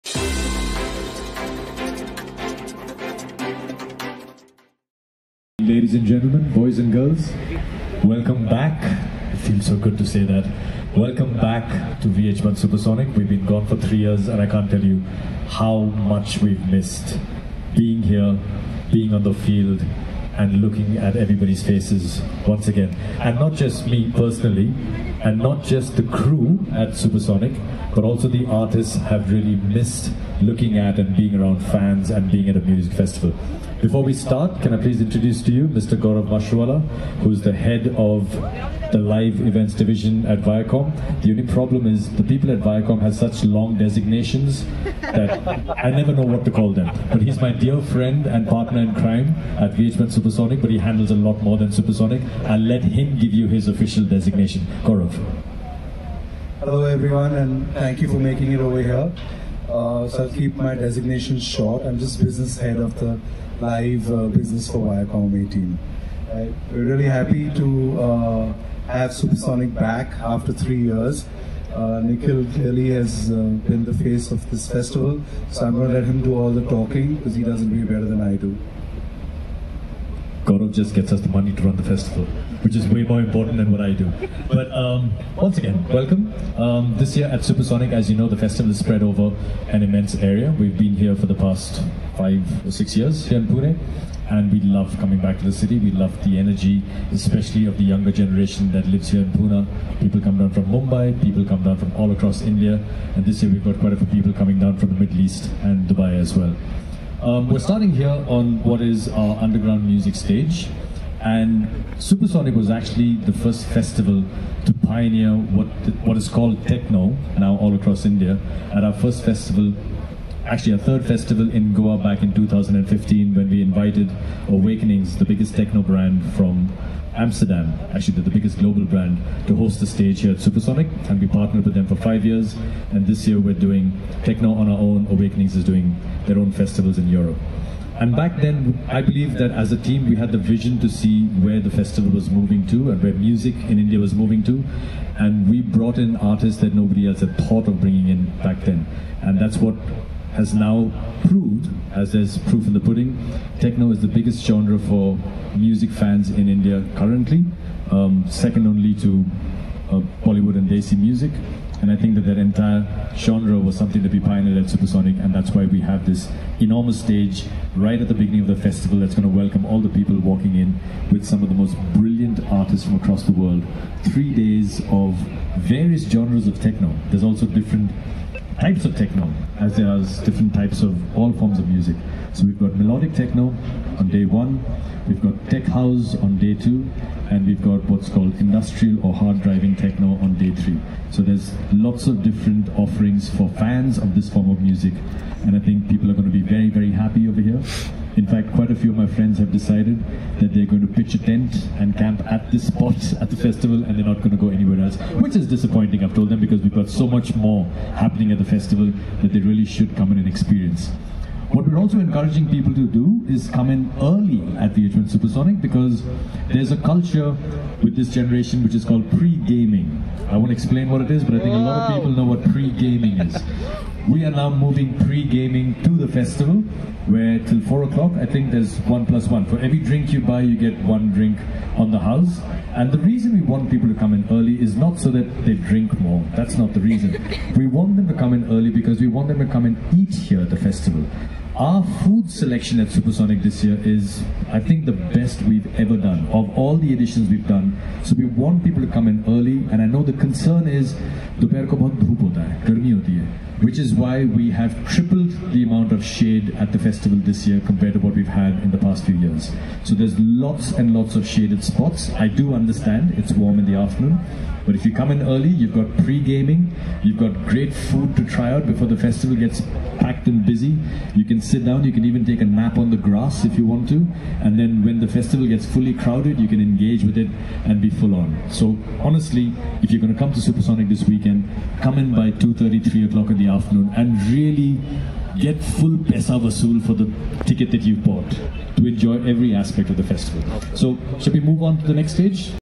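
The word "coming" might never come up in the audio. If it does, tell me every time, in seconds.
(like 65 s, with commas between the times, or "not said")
94 s, 104 s, 213 s.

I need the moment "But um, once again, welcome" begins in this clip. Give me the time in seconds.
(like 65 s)
84 s.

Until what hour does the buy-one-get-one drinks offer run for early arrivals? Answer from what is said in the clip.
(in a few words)
4 o'clock.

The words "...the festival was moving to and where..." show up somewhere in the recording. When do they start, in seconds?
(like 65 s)
141 s.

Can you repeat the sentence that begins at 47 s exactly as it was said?
But he's my dear friend and partner in crime at Viacom Supersonic, but he handles a lot more than Supersonic.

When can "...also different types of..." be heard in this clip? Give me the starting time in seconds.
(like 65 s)
177 s.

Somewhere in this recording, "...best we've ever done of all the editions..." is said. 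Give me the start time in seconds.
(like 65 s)
244 s.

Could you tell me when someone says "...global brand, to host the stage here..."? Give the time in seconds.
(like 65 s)
128 s.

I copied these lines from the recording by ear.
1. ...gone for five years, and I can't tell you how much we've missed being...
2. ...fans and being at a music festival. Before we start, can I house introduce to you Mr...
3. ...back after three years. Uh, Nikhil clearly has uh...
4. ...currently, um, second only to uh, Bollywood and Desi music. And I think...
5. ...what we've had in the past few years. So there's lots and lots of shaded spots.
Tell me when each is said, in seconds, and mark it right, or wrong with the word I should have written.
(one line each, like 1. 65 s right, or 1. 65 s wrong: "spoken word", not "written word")
1. 13 s wrong: "three", not "five"
2. 31 s wrong: "please", not "house"
3. 69 s right
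4. 156 s right
5. 257 s right.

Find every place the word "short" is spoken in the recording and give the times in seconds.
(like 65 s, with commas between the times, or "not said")
61 s.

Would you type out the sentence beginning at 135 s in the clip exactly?
Awakenings is doing their own festivals in Europe.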